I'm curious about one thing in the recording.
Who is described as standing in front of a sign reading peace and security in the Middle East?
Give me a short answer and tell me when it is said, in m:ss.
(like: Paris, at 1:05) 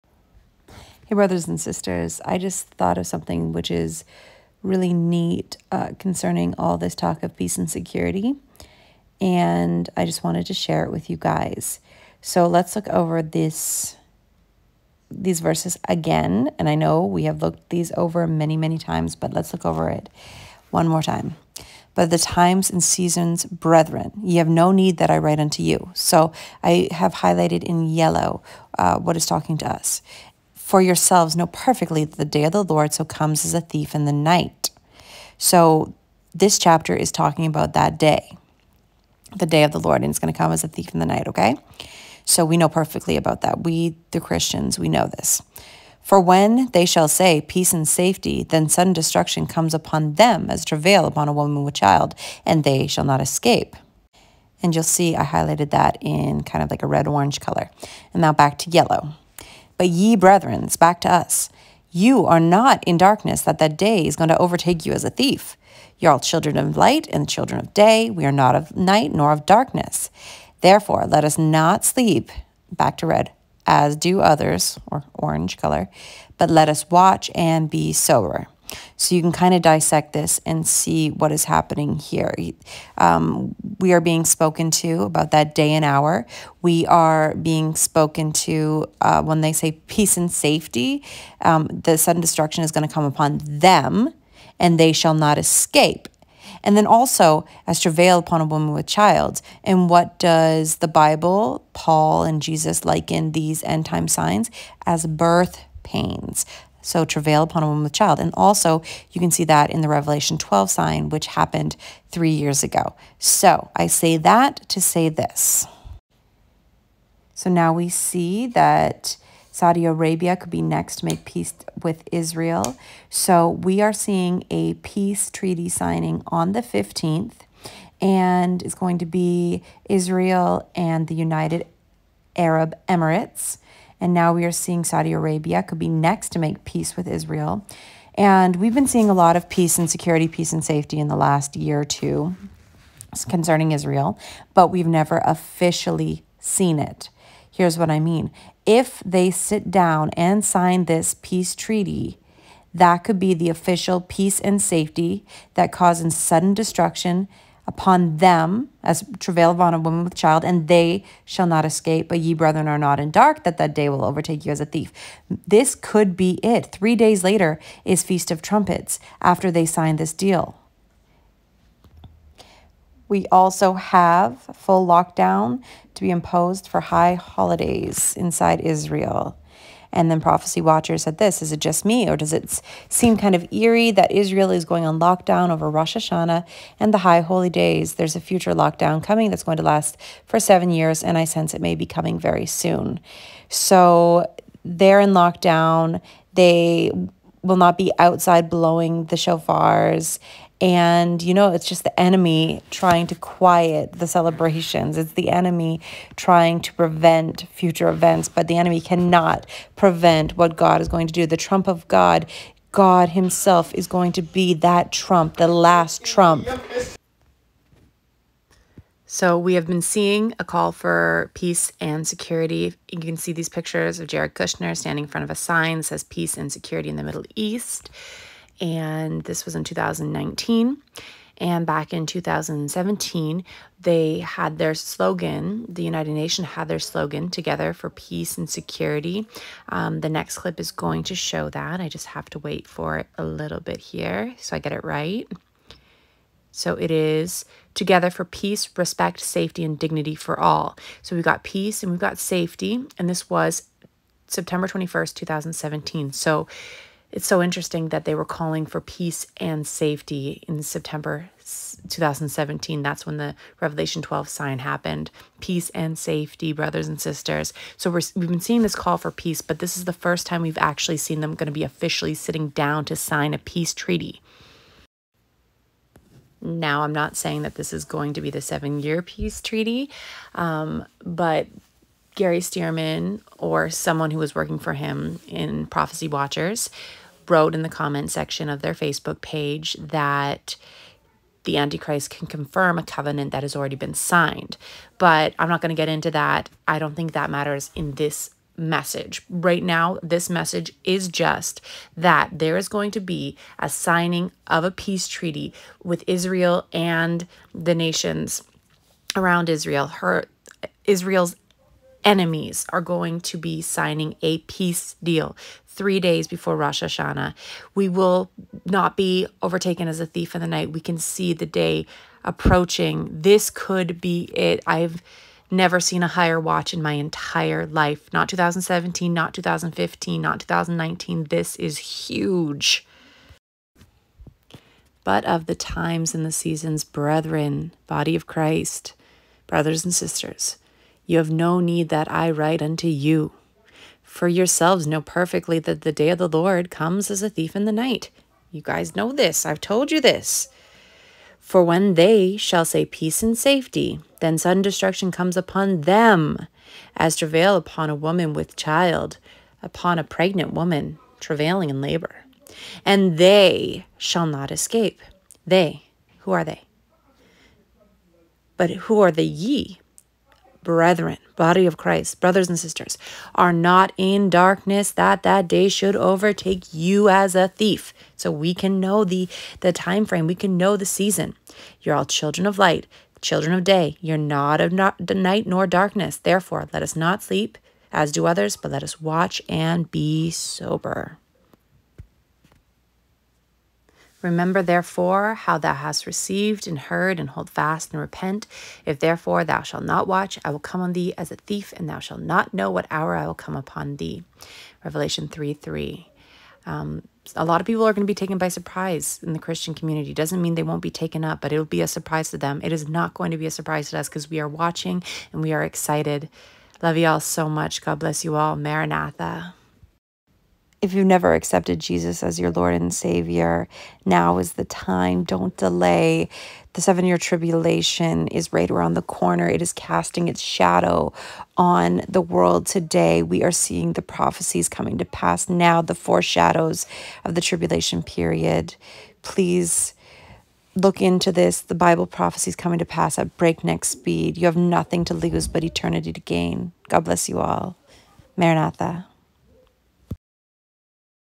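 Jared Kushner, at 3:44.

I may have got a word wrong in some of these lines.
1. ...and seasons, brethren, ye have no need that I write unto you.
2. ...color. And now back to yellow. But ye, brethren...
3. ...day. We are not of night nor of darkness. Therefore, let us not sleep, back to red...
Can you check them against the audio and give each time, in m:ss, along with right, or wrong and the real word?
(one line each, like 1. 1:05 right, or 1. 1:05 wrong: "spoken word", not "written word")
1. 0:22 right
2. 0:57 right
3. 1:07 right.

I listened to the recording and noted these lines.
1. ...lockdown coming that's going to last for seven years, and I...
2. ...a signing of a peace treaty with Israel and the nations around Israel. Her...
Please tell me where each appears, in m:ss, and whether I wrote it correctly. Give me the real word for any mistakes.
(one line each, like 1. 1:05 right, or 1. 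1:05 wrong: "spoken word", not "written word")
1. 3:08 right
2. 5:03 right.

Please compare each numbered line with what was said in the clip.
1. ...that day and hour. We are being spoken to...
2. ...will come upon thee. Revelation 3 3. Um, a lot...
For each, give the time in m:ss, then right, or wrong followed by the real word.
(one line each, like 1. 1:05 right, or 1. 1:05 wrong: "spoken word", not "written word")
1. 1:25 right
2. 6:43 right.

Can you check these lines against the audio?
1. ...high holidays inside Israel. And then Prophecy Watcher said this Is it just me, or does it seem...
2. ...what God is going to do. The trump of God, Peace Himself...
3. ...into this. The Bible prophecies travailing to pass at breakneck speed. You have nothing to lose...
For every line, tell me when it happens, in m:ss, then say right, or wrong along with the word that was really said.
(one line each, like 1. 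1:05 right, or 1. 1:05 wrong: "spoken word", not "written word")
1. 2:56 right
2. 3:30 wrong: "God", not "Peace"
3. 7:20 wrong: "coming", not "travailing".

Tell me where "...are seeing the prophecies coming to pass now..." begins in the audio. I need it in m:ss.
7:13.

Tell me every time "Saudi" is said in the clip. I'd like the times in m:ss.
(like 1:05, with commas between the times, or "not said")
1:59, 2:14.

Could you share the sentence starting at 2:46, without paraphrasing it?
Three days later is Feast of Trumpets after they signed this deal.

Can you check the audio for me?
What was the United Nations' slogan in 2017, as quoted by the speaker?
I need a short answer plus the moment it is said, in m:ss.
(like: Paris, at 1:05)
Together for Peace and Security, at 3:57.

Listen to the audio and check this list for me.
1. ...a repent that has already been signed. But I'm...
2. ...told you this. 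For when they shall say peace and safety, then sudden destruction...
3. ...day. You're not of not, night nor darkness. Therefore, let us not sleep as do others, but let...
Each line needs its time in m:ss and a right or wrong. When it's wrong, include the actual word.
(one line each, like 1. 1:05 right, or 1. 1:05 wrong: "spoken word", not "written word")
1. 4:52 wrong: "covenant", not "repent"
2. 5:49 right
3. 6:23 right.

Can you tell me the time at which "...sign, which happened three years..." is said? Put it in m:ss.
1:50.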